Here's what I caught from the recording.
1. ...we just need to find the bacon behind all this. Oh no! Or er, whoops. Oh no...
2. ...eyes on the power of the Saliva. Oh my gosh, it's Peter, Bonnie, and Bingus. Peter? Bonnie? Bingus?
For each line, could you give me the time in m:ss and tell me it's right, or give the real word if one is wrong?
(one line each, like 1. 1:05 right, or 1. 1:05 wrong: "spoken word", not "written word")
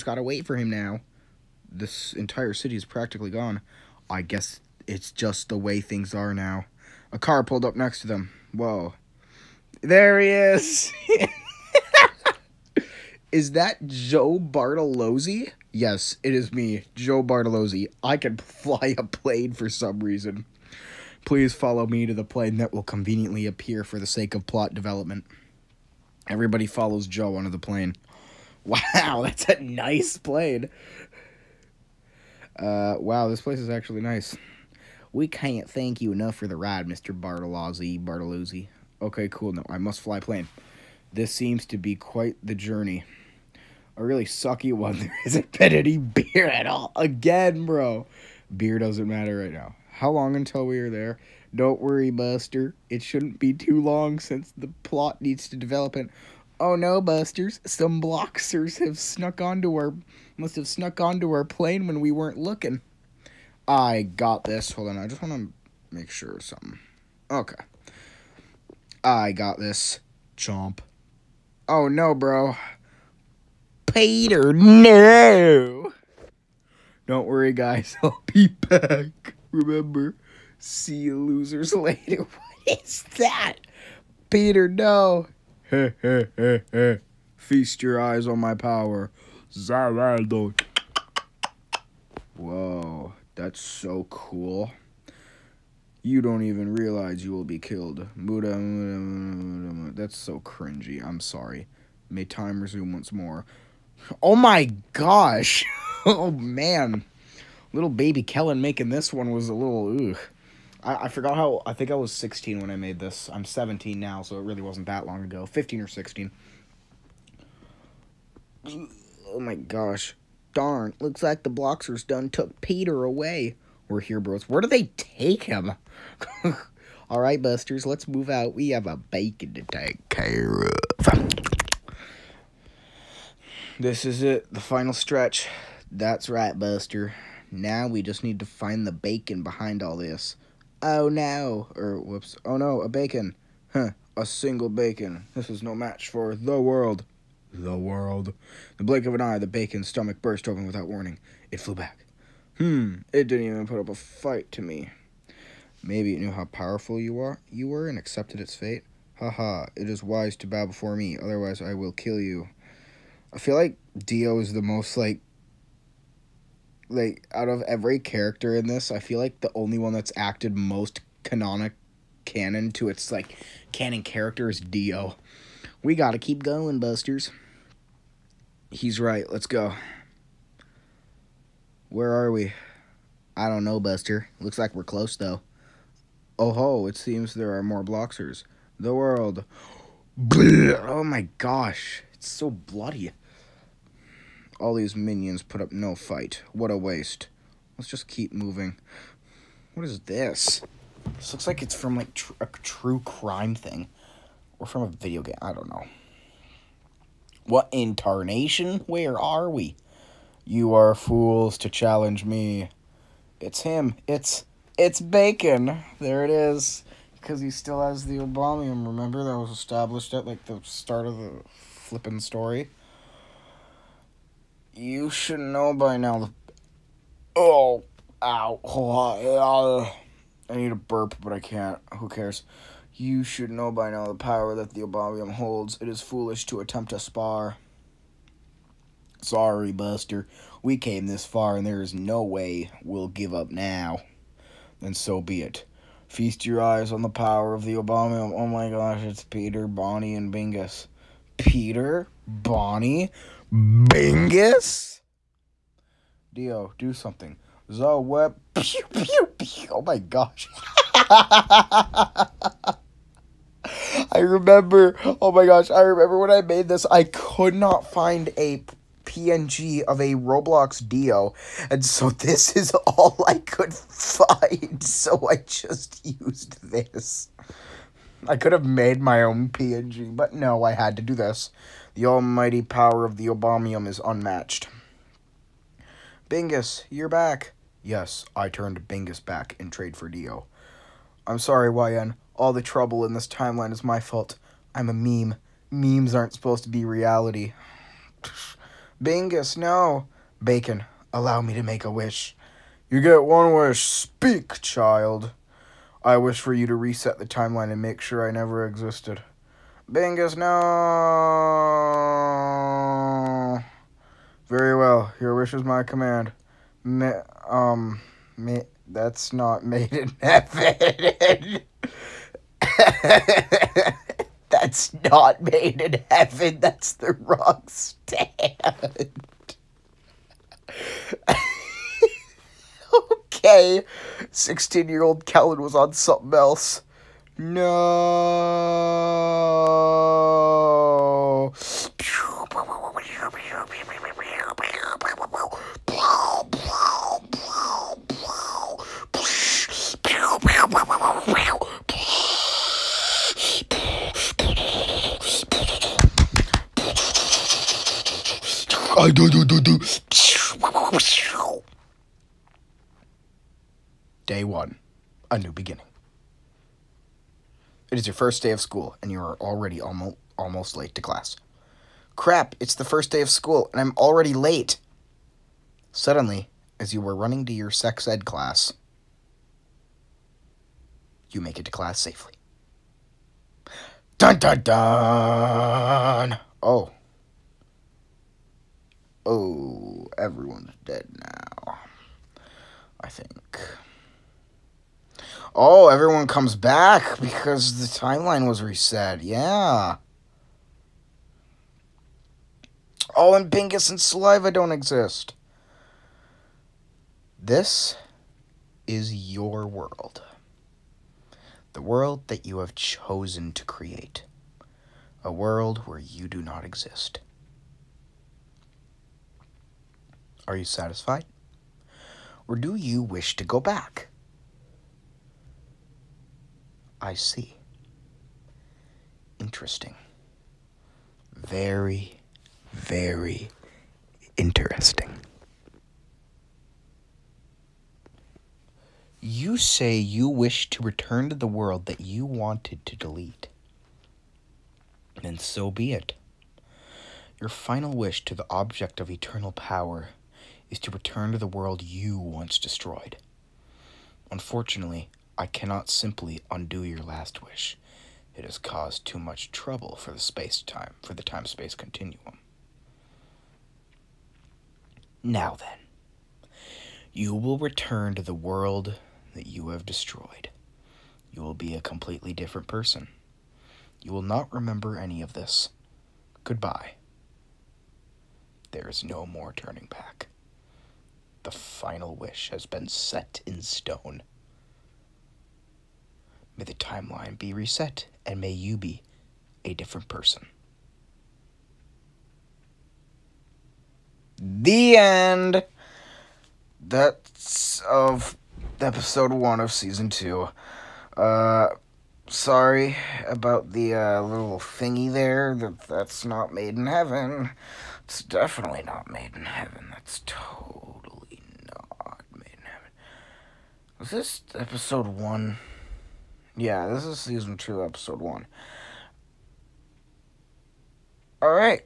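1. 2:17 right
2. 4:06 wrong: "Obamium", not "Saliva".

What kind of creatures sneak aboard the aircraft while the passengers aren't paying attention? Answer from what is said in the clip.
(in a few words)
Blocksters.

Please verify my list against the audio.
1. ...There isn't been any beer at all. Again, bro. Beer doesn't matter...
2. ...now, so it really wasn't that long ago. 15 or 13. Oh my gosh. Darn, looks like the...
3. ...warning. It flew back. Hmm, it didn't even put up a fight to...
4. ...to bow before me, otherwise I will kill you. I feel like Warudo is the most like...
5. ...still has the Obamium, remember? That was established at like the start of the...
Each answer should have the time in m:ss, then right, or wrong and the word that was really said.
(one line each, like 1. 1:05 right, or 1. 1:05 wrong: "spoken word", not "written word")
1. 0:44 right
2. 1:53 wrong: "16", not "13"
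3. 2:30 right
4. 2:40 wrong: "Dio", not "Warudo"
5. 3:37 right.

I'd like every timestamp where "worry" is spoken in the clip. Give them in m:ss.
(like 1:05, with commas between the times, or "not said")
0:51, 1:17.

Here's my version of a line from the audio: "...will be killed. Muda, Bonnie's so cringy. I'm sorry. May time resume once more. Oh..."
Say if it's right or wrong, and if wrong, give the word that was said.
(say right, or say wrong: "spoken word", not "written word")
wrong: "That", not "Bonnie".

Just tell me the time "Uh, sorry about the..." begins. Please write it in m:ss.
8:21.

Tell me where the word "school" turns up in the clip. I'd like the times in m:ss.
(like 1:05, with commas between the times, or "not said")
6:08, 6:13.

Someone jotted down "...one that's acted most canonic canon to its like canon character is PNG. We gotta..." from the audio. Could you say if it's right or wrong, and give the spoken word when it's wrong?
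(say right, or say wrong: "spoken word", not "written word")
wrong: "Dio", not "PNG".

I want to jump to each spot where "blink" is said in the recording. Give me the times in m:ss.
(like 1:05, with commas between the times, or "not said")
2:28.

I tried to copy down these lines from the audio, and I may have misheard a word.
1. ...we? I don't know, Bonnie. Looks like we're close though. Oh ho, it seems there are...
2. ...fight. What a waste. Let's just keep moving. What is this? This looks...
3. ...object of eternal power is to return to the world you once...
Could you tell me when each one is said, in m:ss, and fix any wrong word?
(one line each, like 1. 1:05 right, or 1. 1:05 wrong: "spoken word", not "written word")
1. 3:02 wrong: "Buster", not "Bonnie"
2. 3:15 right
3. 7:28 right.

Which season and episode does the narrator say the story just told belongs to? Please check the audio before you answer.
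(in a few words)
Season 2, episode 1.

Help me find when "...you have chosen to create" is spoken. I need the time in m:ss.
6:52.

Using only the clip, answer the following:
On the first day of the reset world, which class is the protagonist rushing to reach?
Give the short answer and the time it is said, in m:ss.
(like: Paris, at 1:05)
Sex ed, at 6:17.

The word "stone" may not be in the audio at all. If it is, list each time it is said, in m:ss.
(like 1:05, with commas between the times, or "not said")
8:03.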